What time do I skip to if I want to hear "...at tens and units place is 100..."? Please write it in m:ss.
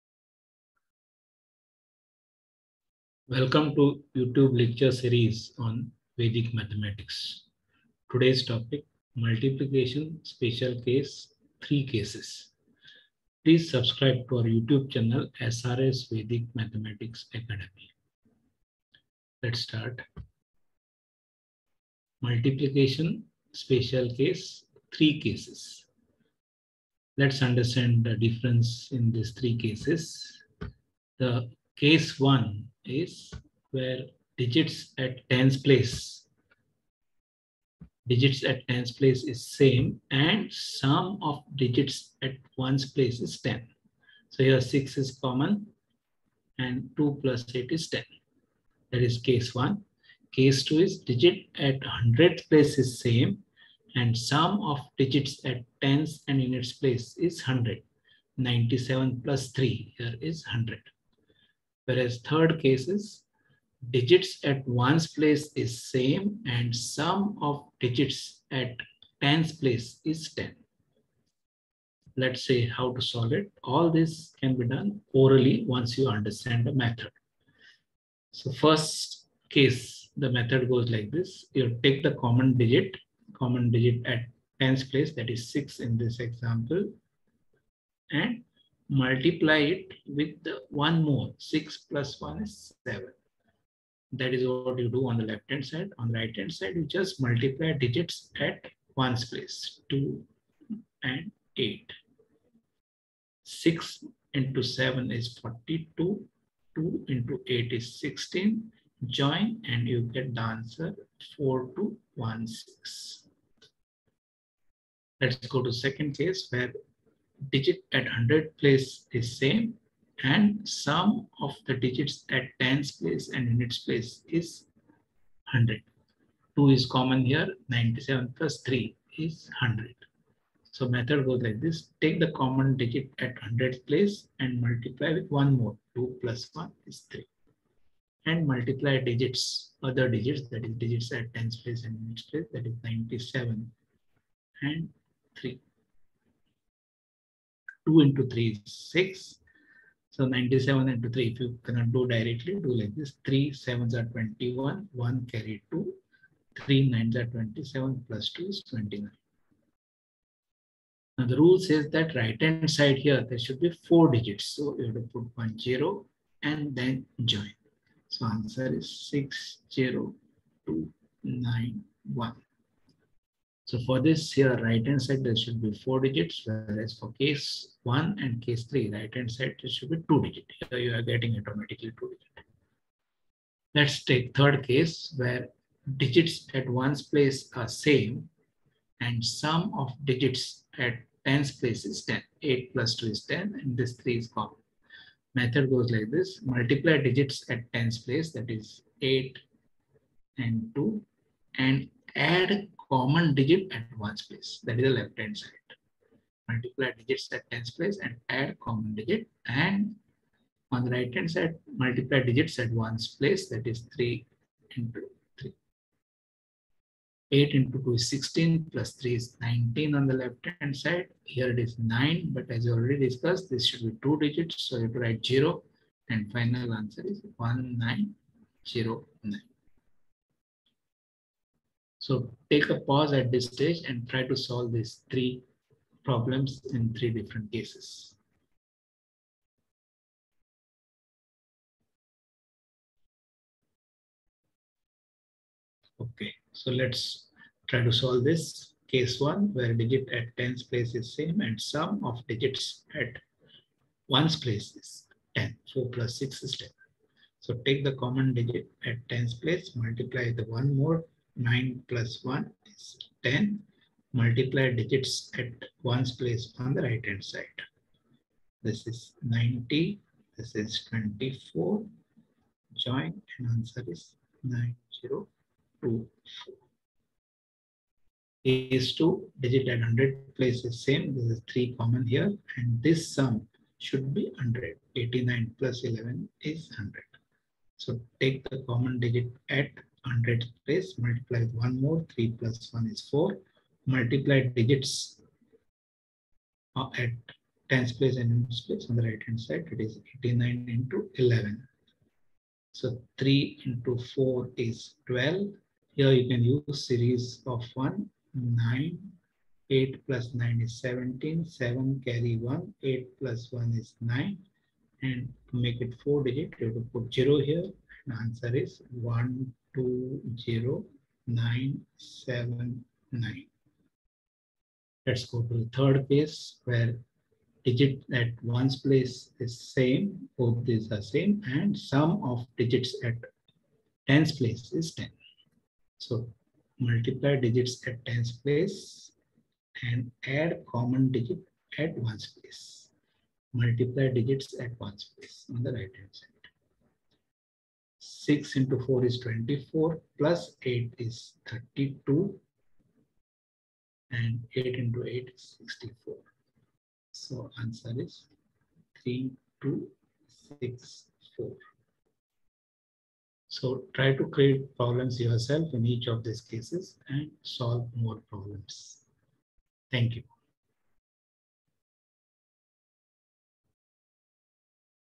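0:55.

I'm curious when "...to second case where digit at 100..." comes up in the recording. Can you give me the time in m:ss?
1:55.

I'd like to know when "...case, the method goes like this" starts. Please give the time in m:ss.
1:19.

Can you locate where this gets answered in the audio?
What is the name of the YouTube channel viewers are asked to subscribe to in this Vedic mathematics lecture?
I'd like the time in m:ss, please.
0:15.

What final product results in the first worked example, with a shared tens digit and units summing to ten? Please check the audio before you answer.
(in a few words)
4216.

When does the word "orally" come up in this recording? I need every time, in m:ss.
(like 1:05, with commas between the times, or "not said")
1:15.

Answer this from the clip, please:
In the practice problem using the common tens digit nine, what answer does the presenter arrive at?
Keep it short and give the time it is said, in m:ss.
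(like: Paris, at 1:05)
9024, at 4:34.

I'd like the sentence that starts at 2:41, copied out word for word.
Now the rule says that right hand side here, there should be 4 digits.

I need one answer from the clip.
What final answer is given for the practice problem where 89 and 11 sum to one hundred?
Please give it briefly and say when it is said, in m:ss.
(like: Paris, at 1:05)
120979, at 5:18.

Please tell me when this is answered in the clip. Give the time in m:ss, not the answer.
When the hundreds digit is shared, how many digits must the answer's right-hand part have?
2:55.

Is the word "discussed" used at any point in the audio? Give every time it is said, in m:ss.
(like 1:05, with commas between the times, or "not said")
3:43.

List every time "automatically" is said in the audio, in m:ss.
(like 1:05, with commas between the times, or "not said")
3:01.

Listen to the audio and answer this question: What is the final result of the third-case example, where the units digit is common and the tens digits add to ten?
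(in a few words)
1909.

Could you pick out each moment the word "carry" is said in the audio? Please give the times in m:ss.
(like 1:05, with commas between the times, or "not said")
2:35, 5:12.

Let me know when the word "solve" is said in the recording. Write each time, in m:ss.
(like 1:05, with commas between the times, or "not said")
1:13, 3:54, 4:07, 6:07.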